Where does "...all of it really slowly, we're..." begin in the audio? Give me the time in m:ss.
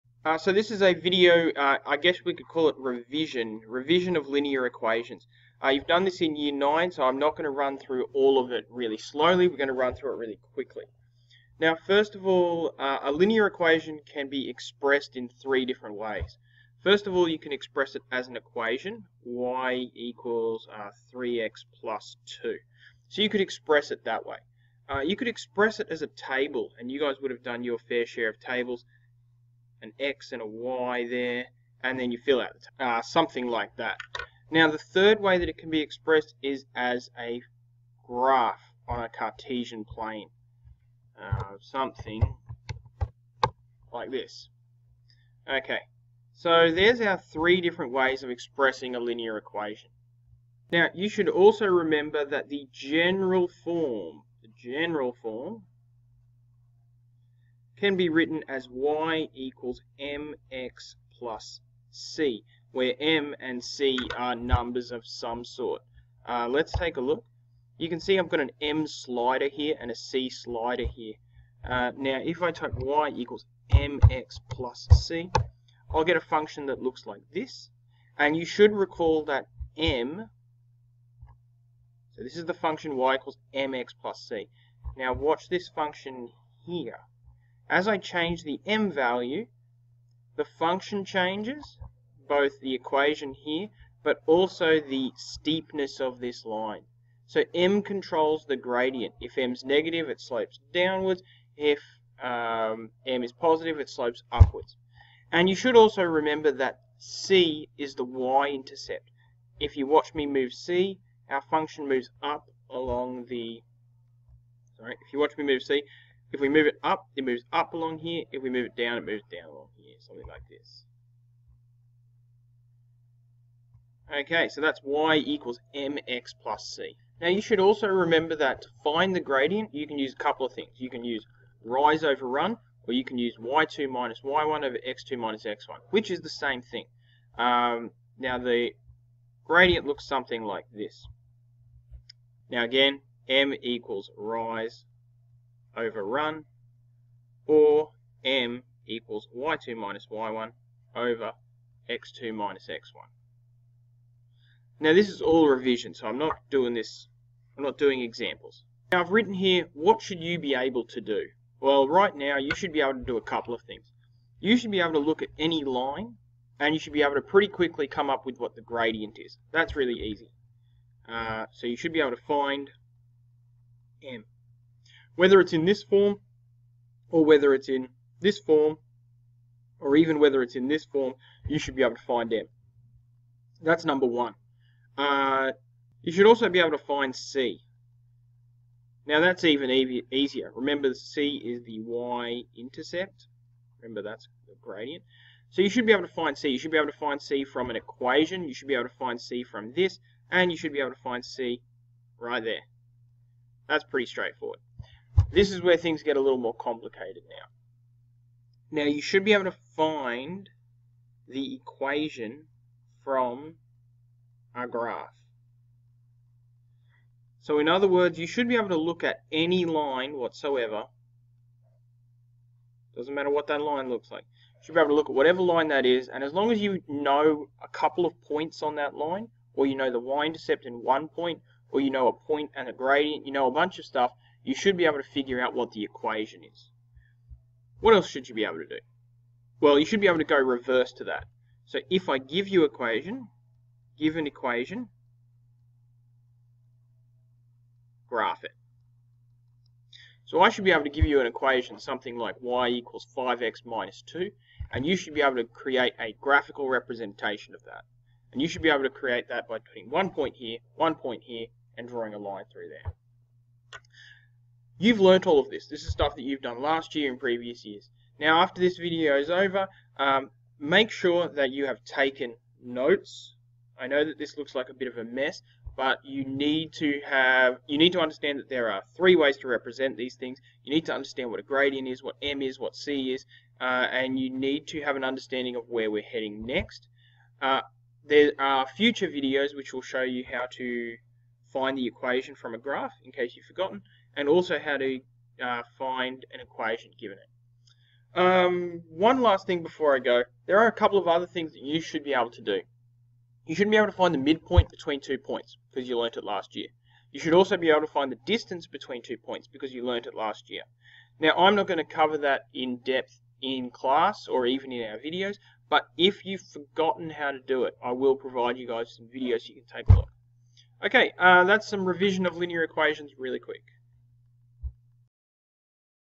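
0:08.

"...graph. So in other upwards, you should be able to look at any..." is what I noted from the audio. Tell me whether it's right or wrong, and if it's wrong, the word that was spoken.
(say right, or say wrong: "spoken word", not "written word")
wrong: "words", not "upwards".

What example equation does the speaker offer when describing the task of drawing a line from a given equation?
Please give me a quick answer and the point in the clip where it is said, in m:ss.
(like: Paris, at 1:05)
y = 5x - 2, at 4:12.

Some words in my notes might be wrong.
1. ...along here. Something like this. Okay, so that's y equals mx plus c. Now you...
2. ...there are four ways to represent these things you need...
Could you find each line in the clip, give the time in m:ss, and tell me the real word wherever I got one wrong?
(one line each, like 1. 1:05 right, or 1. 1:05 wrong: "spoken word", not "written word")
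1. 1:59 right
2. 4:38 wrong: "three", not "four".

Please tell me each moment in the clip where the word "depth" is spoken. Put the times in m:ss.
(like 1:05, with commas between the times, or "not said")
5:12.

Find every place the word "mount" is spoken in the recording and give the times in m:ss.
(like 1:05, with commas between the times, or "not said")
not said.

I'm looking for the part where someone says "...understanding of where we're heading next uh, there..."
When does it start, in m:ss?
4:45.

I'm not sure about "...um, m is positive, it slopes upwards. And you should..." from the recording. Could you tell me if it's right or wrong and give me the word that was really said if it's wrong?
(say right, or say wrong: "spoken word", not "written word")
right.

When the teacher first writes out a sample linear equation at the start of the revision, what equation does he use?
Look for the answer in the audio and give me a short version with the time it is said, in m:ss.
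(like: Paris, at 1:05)
y = 3x + 2, at 0:19.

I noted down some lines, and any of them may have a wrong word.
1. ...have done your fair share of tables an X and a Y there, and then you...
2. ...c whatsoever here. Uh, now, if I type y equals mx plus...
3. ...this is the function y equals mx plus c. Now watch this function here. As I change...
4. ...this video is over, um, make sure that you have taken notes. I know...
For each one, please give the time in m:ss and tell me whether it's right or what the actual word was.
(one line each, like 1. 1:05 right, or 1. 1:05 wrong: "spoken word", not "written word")
1. 0:27 right
2. 1:09 wrong: "slider", not "whatsoever"
3. 1:22 right
4. 4:28 right.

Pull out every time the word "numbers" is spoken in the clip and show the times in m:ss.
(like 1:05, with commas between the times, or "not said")
1:04, 3:03.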